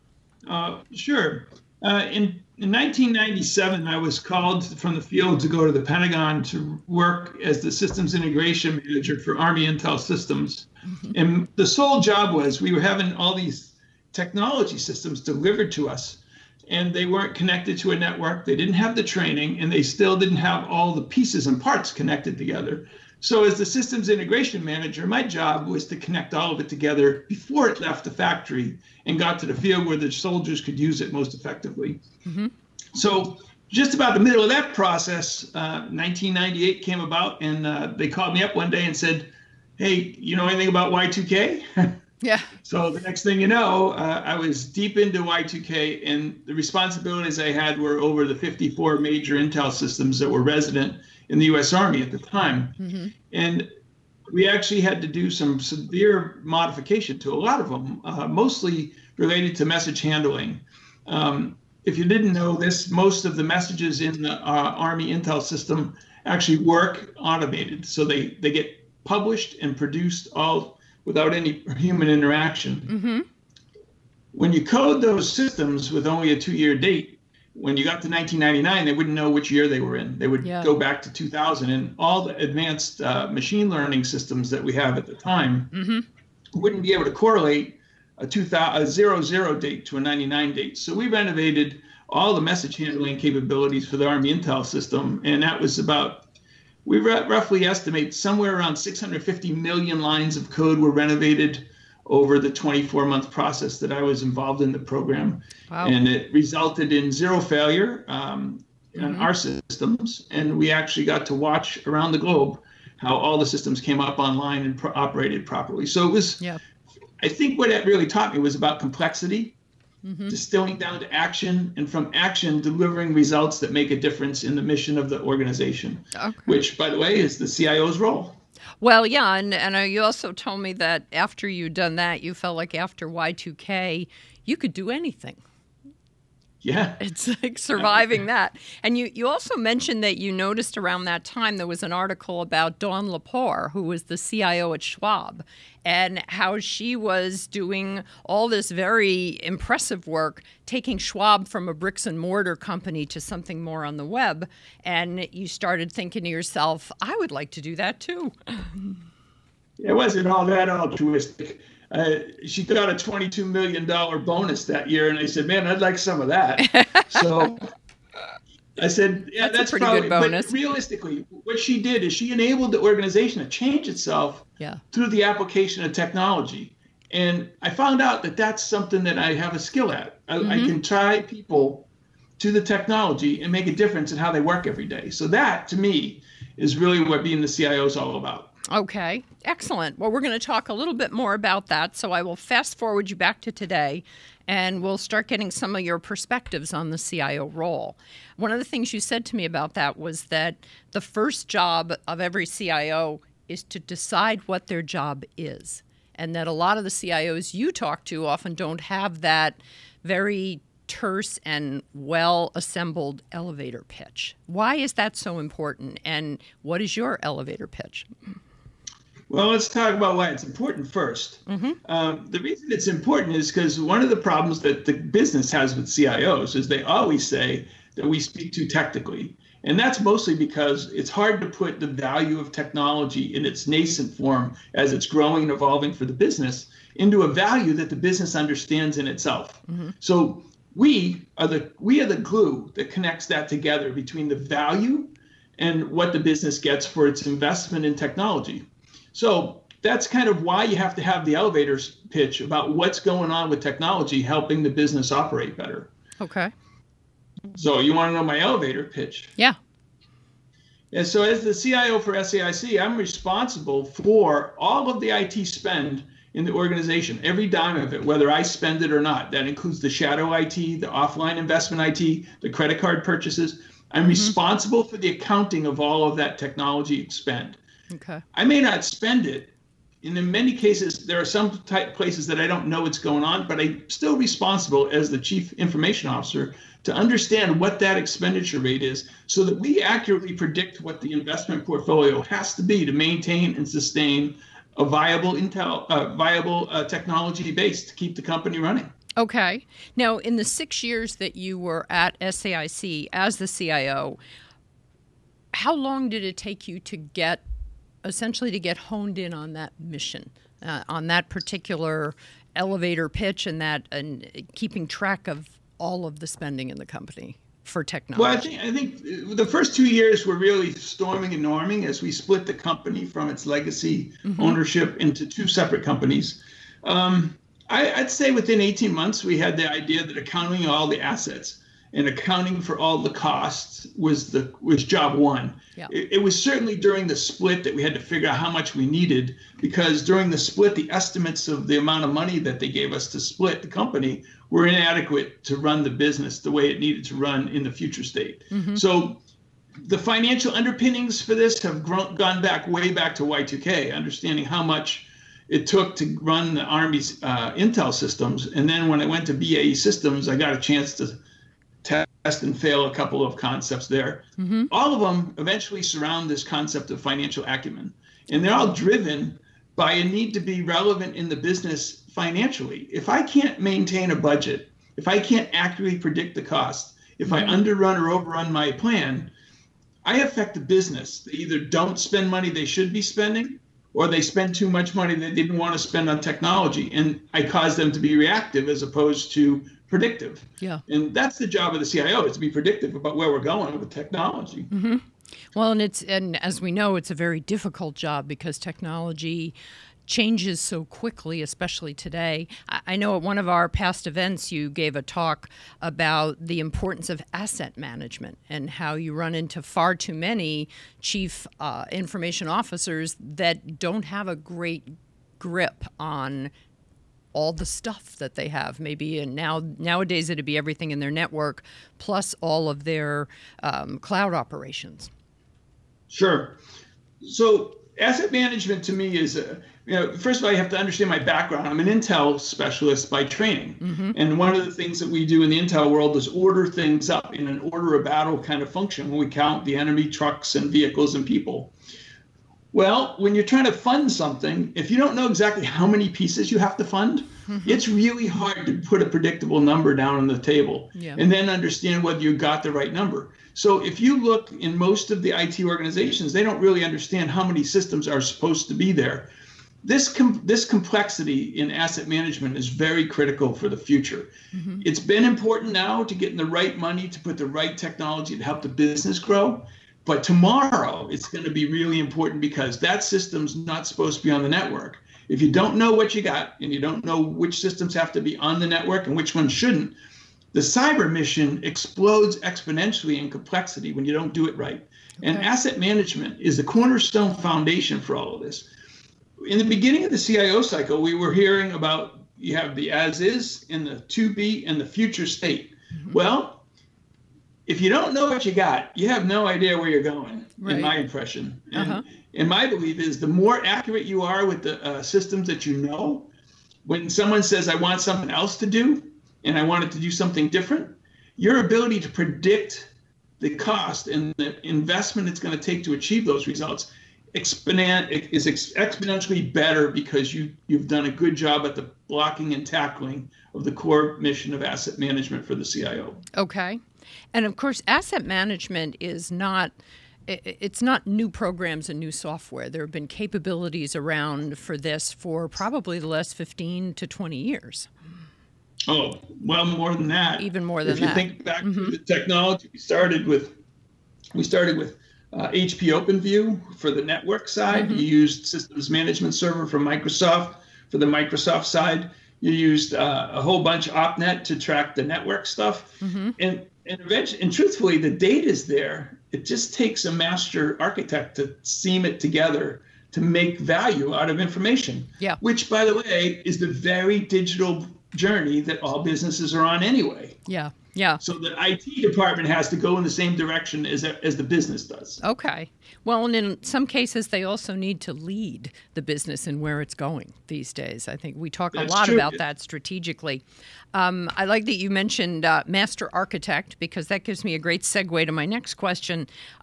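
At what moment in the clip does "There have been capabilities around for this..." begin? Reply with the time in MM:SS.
08:52.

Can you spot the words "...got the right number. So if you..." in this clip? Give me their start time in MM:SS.
07:32.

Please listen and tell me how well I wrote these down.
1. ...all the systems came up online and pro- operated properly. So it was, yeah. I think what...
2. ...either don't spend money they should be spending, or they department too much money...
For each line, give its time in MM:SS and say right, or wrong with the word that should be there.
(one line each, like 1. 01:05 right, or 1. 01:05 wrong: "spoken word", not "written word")
1. 01:53 right
2. 06:21 wrong: "spent", not "department".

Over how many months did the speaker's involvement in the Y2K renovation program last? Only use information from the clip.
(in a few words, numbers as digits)
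24 months.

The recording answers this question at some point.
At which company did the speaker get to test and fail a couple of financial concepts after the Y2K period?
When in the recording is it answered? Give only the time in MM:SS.
05:59.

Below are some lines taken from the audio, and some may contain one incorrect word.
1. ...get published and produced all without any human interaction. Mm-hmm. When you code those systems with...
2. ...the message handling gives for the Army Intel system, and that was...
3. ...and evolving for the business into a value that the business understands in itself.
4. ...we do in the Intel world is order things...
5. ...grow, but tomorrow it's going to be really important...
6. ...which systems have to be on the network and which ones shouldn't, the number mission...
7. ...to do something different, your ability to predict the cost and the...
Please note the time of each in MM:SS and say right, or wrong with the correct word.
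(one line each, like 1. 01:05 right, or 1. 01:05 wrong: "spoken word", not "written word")
1. 01:08 right
2. 01:32 wrong: "capabilities", not "gives"
3. 03:55 right
4. 07:15 right
5. 07:49 right
6. 07:57 wrong: "cyber", not "number"
7. 08:29 right.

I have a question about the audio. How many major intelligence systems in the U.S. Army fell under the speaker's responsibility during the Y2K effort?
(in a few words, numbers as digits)
54.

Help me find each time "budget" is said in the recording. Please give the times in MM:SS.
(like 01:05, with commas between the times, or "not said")
06:14.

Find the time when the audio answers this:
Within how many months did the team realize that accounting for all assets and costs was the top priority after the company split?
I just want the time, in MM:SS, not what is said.
05:28.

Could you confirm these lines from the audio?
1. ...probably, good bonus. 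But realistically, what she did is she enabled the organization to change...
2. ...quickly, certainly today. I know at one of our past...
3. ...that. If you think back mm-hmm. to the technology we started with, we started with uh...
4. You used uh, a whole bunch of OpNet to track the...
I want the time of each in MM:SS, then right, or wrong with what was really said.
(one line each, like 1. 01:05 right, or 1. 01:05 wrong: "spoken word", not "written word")
1. 02:49 right
2. 06:40 wrong: "especially", not "certainly"
3. 09:00 right
4. 09:12 right.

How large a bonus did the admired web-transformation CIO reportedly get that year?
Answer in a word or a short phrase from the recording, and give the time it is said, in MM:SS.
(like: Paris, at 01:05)
$22 million, at 02:42.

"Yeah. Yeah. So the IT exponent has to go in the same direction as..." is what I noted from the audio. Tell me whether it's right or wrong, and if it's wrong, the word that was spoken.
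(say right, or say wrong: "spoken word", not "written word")
wrong: "department", not "exponent".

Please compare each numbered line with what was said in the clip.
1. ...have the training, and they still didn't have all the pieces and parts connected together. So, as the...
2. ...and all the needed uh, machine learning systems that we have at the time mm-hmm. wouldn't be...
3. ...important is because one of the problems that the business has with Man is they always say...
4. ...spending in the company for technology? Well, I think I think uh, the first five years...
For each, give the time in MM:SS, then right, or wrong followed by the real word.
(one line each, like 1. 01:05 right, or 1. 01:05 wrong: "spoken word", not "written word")
1. 00:18 right
2. 01:21 wrong: "advanced", not "needed"
3. 03:42 wrong: "CIOs", not "Man"
4. 05:16 wrong: "two", not "five".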